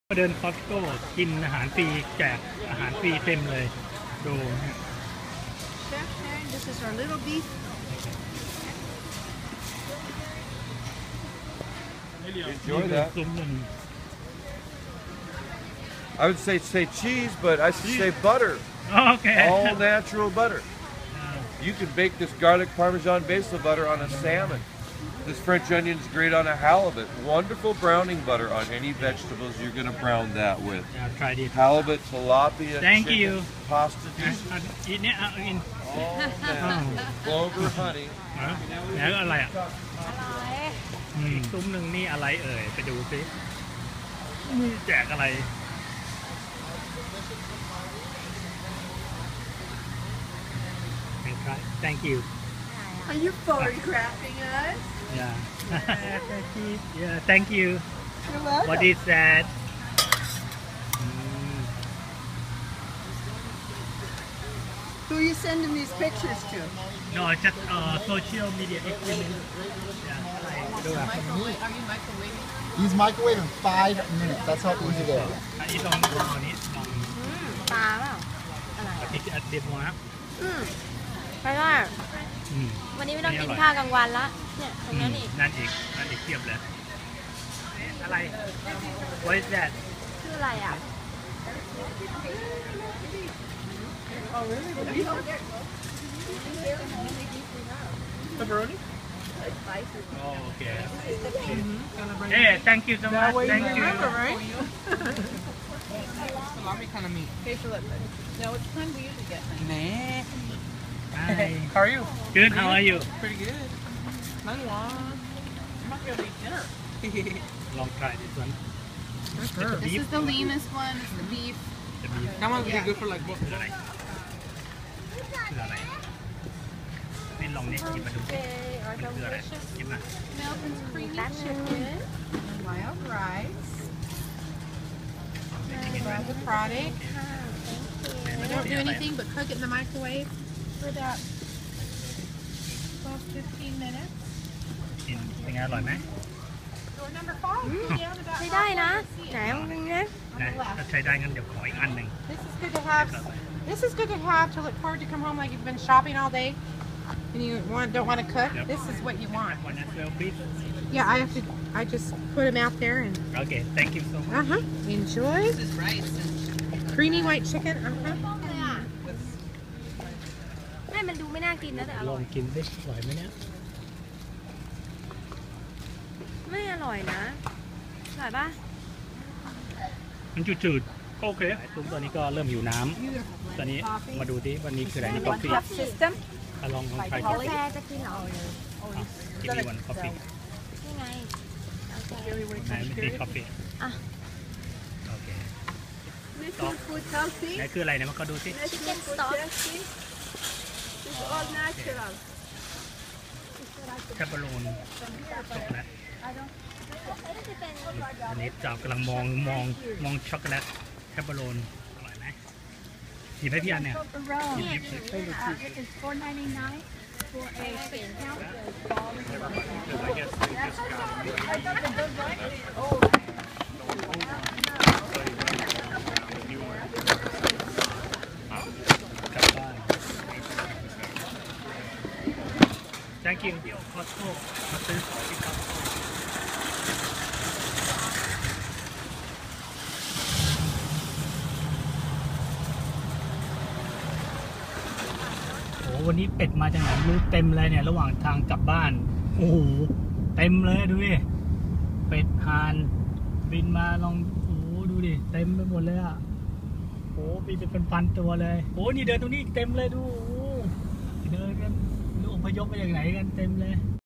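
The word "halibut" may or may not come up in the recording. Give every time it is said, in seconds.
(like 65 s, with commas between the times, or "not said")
26 s, 31 s.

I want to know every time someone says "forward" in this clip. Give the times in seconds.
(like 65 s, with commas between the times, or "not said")
154 s.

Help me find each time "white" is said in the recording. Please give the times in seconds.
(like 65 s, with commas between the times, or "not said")
167 s.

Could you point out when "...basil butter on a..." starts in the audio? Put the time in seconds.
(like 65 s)
23 s.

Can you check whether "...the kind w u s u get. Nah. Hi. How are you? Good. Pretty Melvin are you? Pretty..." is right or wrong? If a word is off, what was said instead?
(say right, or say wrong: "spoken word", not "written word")
wrong: "How", not "Melvin".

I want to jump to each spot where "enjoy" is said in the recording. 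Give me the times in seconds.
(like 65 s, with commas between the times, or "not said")
12 s, 164 s.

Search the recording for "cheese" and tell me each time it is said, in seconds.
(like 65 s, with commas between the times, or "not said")
17 s.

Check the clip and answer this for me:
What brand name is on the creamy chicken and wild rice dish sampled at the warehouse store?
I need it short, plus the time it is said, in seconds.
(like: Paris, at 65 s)
Melvin's, at 130 s.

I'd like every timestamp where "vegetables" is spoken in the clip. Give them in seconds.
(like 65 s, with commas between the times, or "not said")
28 s.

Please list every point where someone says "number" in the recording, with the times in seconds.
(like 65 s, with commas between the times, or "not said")
147 s.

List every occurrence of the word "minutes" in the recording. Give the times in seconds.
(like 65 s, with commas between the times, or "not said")
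74 s, 143 s.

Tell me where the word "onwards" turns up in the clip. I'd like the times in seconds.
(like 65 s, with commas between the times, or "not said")
not said.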